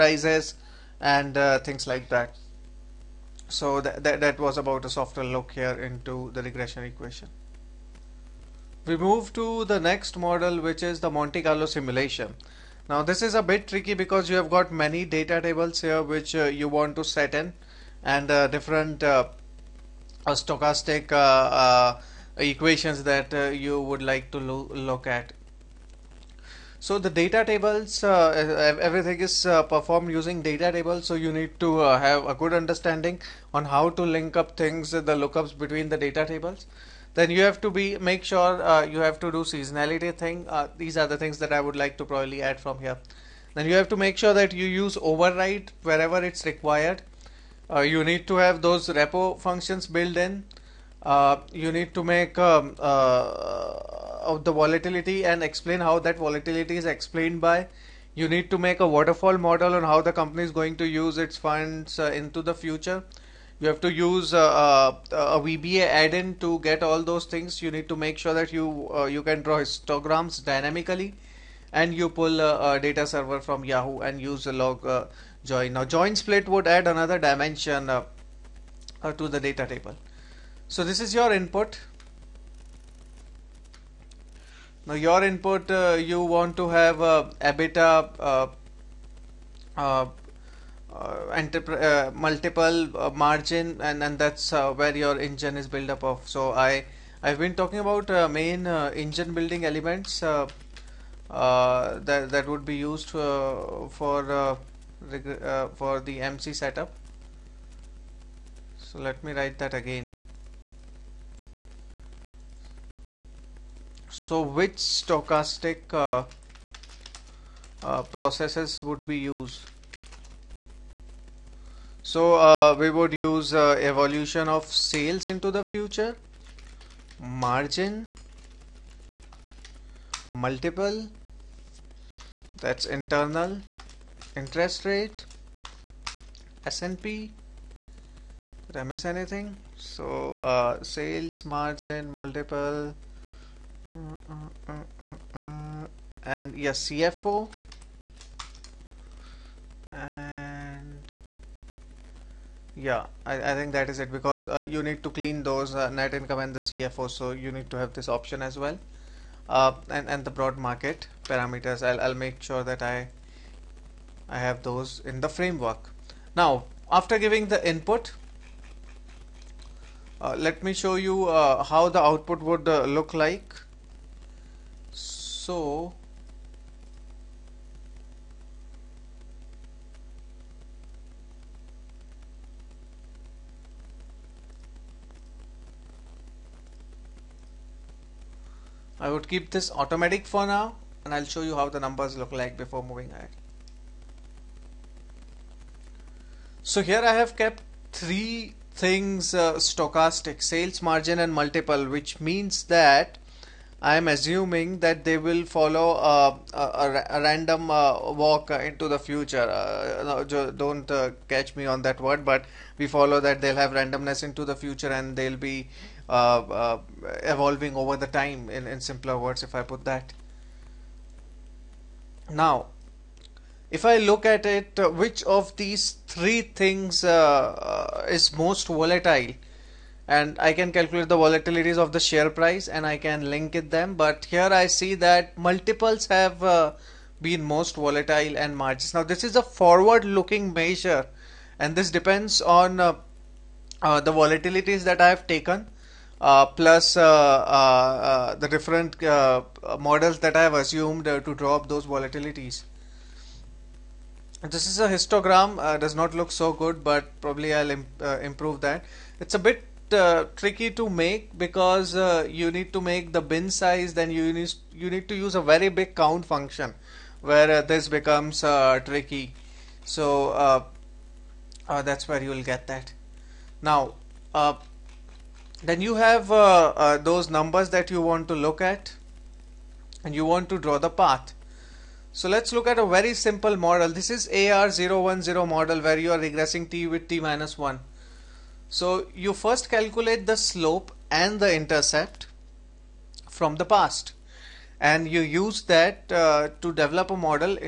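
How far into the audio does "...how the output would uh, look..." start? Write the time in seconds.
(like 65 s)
171 s.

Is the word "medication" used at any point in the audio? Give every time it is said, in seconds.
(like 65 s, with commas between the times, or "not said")
not said.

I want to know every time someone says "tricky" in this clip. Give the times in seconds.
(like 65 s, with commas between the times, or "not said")
13 s, 260 s, 268 s.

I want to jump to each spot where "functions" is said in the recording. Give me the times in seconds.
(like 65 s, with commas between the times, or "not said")
49 s, 266 s.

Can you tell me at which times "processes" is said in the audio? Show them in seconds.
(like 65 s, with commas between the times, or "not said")
118 s.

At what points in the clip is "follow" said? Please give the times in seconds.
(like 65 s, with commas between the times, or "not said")
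205 s, 212 s.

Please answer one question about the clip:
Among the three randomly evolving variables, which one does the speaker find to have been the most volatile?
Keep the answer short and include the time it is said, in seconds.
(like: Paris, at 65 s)
multiples, at 235 s.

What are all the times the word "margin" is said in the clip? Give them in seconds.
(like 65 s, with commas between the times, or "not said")
93 s, 127 s, 141 s, 200 s, 238 s.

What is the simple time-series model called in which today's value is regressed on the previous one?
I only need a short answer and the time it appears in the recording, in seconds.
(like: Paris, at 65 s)
AR010 model, at 284 s.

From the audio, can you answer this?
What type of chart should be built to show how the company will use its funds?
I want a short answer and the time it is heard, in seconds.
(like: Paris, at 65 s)
waterfall model, at 58 s.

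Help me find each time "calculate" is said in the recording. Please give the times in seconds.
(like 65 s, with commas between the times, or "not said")
230 s, 289 s.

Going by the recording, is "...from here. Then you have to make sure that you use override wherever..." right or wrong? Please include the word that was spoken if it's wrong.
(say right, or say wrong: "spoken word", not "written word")
right.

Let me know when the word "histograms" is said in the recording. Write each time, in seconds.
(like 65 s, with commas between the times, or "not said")
69 s, 254 s.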